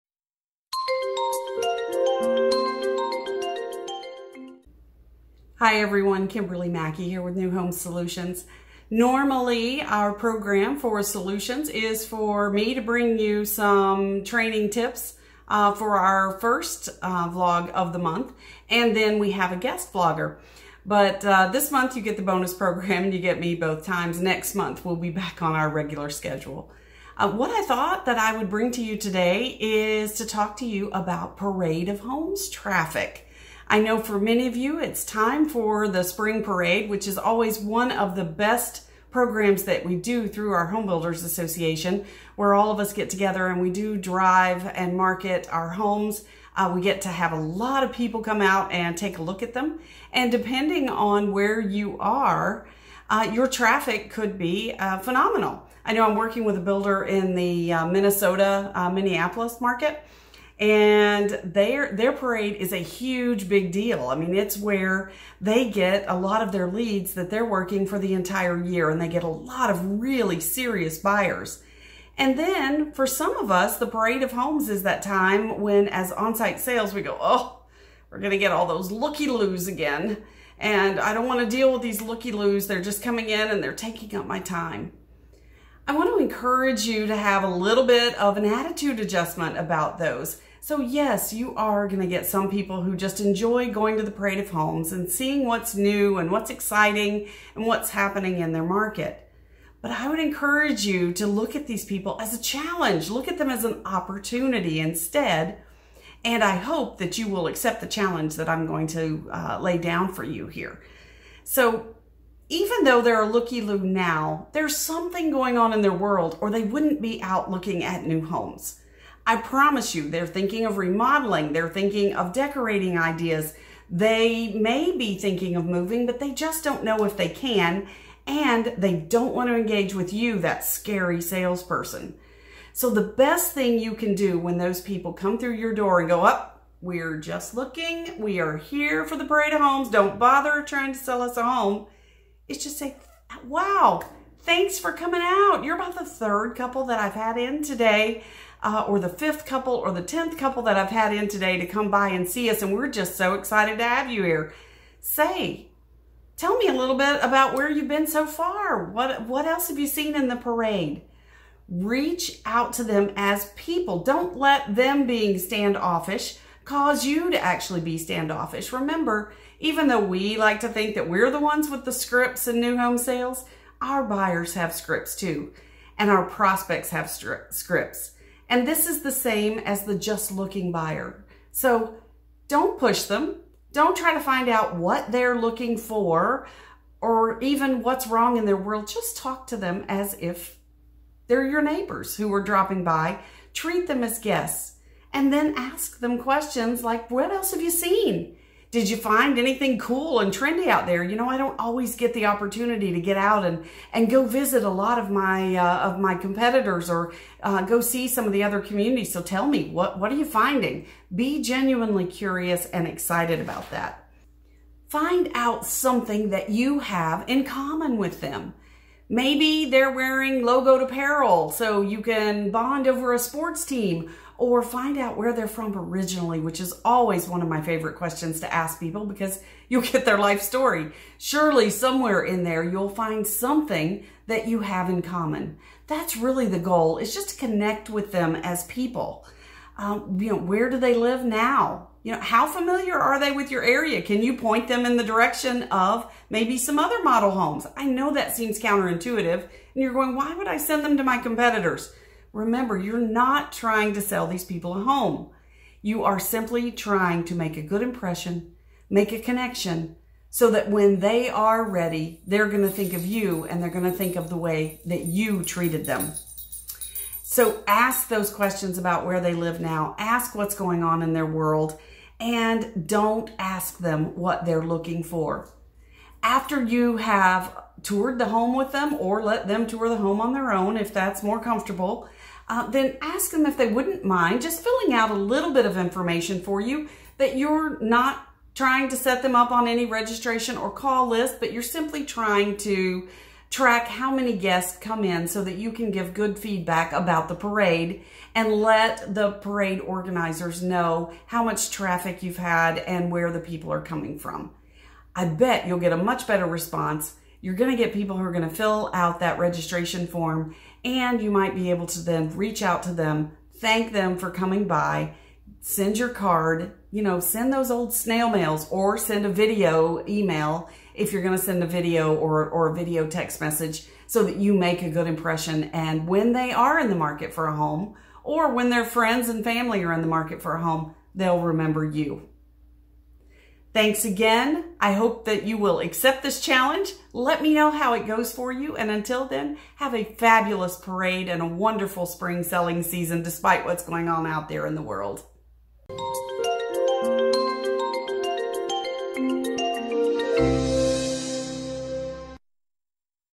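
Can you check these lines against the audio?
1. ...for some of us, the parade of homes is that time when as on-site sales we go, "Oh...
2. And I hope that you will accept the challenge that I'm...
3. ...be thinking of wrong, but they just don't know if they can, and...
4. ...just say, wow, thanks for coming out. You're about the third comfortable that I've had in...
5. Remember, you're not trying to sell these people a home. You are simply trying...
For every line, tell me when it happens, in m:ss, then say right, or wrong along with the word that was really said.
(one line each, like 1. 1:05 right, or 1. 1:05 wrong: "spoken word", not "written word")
1. 1:12 right
2. 1:46 right
3. 2:04 wrong: "moving", not "wrong"
4. 2:22 wrong: "couple", not "comfortable"
5. 4:12 right.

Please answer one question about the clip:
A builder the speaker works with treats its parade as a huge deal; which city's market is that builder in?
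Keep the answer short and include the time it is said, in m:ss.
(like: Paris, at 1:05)
Minneapolis, at 0:58.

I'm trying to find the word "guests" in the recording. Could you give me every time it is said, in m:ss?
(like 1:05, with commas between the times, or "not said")
0:19, 3:14, 4:54.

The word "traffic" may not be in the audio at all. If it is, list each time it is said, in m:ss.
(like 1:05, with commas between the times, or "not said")
0:32, 0:53, 5:01.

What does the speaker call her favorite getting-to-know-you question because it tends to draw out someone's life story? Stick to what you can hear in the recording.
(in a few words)
where they're from originally.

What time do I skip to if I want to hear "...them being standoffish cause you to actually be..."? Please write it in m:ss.
2:44.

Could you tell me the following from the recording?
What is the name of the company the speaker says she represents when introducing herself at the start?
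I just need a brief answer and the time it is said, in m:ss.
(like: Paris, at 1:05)
New Home Solutions, at 0:07.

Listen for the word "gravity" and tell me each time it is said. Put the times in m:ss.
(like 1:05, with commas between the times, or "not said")
not said.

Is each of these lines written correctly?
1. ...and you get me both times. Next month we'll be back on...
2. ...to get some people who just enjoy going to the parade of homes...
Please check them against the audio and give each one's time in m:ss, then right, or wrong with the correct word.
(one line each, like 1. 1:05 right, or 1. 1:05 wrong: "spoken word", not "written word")
1. 0:23 right
2. 1:31 right.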